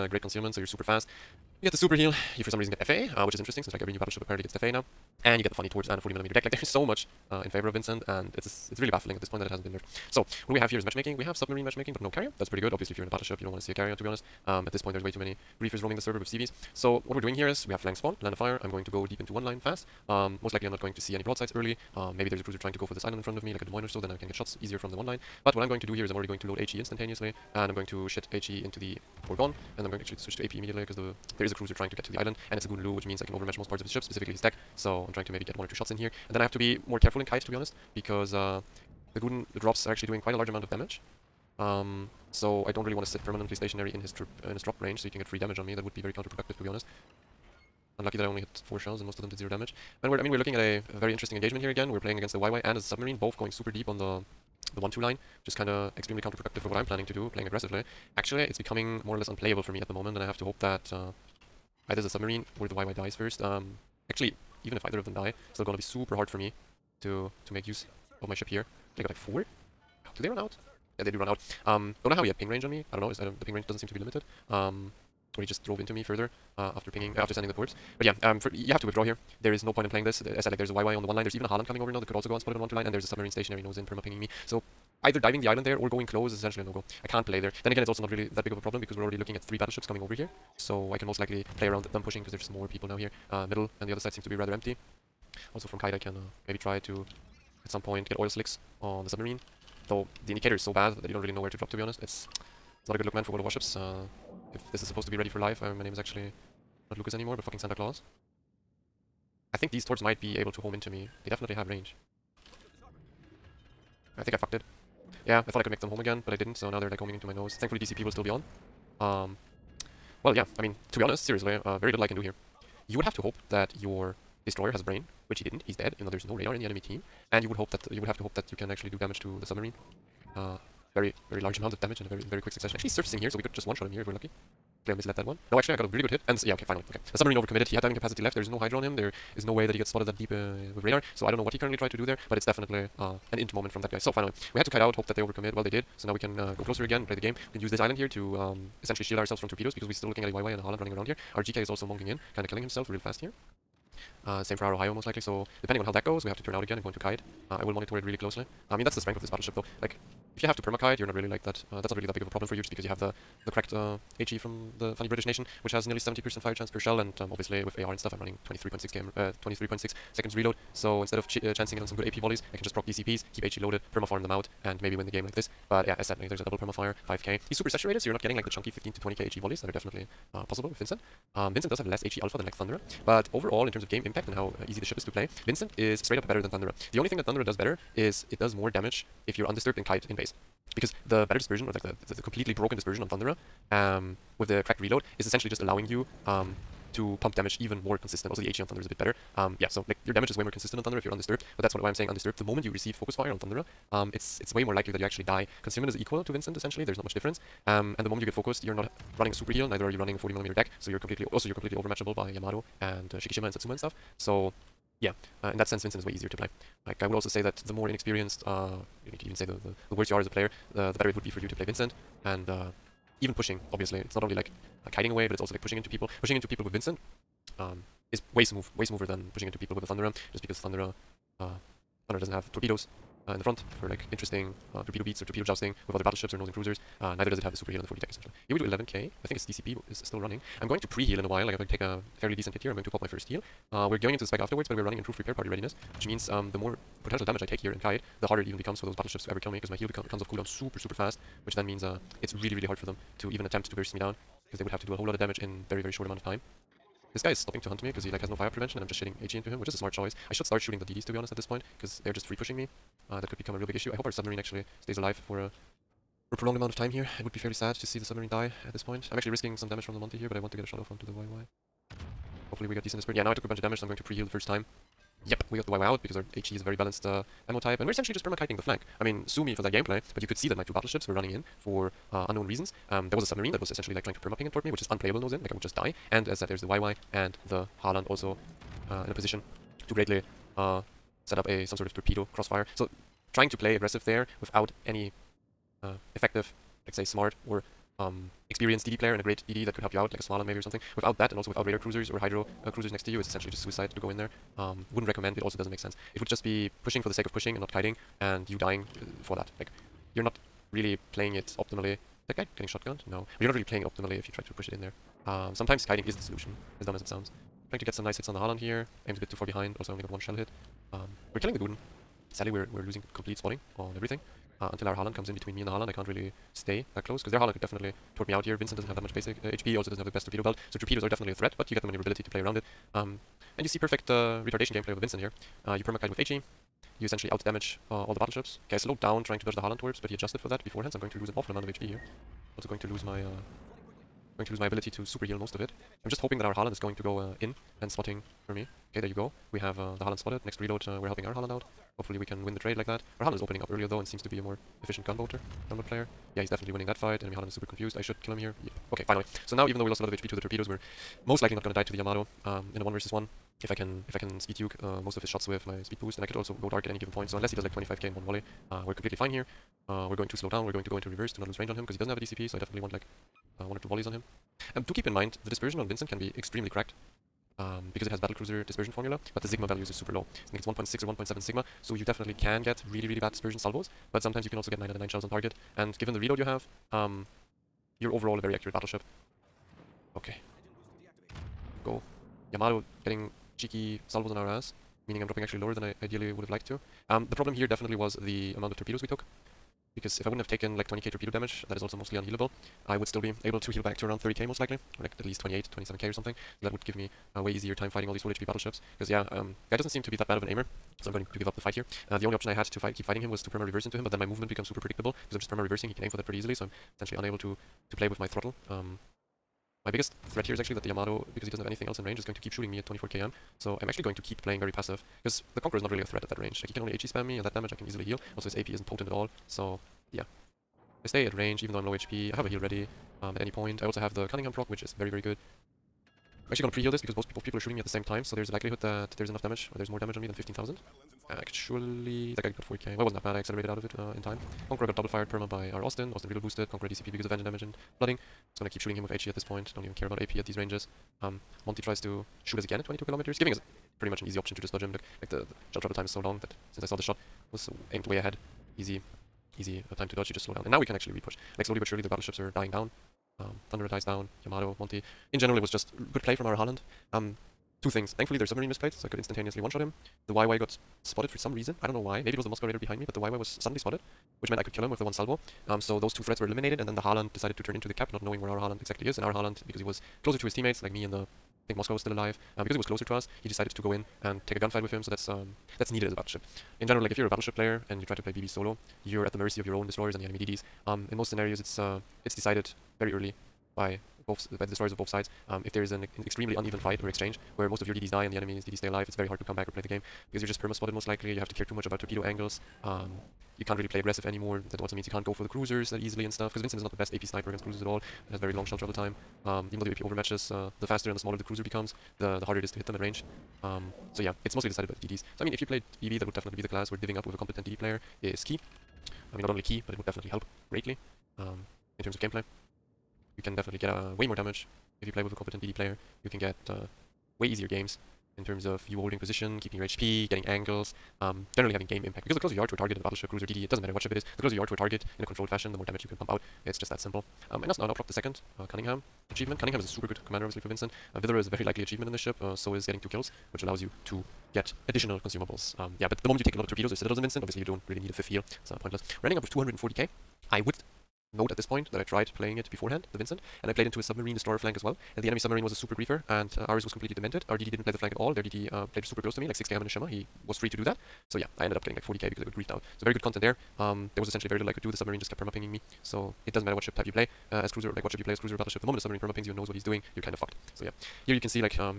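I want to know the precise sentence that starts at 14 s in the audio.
Um, at this point there's way too many griefers roaming the server with CVs.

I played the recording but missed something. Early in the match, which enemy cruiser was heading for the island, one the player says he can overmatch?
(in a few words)
Gouden Leeuw.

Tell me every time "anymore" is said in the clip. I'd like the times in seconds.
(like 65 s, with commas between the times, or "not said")
107 s, 504 s.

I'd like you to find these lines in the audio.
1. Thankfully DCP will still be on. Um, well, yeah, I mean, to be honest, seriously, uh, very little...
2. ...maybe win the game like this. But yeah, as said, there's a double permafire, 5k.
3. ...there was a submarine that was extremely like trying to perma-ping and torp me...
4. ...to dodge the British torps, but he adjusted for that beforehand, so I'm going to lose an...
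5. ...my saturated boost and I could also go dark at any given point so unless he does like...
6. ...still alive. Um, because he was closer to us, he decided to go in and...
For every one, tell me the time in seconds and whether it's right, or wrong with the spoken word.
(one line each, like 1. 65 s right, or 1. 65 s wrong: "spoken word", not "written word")
1. 117 s right
2. 174 s right
3. 283 s wrong: "essentially", not "extremely"
4. 339 s wrong: "Halland", not "British"
5. 365 s wrong: "speed", not "saturated"
6. 482 s right.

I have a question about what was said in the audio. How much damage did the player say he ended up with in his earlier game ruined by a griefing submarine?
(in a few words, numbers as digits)
40k.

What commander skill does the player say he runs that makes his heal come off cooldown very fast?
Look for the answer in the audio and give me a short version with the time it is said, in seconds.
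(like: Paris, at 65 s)
improved repair party readiness, at 244 s.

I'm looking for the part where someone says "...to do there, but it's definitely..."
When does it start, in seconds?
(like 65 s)
141 s.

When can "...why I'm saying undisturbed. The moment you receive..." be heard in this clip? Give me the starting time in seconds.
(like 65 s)
201 s.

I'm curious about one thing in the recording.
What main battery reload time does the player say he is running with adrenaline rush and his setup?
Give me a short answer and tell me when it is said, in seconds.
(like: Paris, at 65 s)
23.6 seconds, at 169 s.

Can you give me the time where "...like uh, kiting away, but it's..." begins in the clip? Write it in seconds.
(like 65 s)
224 s.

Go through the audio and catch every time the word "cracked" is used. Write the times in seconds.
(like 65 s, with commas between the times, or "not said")
163 s, 194 s, 376 s.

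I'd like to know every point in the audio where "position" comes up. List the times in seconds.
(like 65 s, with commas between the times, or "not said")
289 s, 529 s.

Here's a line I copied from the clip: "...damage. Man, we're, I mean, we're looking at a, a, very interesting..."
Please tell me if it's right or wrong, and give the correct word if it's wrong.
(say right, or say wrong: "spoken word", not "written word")
right.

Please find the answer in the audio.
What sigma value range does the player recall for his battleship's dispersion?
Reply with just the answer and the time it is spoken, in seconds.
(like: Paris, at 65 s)
1.6 or 1.7, at 380 s.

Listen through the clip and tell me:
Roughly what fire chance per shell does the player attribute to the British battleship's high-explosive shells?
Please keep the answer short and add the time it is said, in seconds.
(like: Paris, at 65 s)
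70%, at 165 s.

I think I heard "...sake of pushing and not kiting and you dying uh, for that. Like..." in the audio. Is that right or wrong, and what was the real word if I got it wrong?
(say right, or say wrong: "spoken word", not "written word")
right.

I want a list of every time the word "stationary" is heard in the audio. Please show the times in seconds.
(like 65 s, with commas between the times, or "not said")
43 s, 83 s.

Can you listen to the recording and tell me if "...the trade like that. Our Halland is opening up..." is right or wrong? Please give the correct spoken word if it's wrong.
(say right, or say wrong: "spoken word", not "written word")
right.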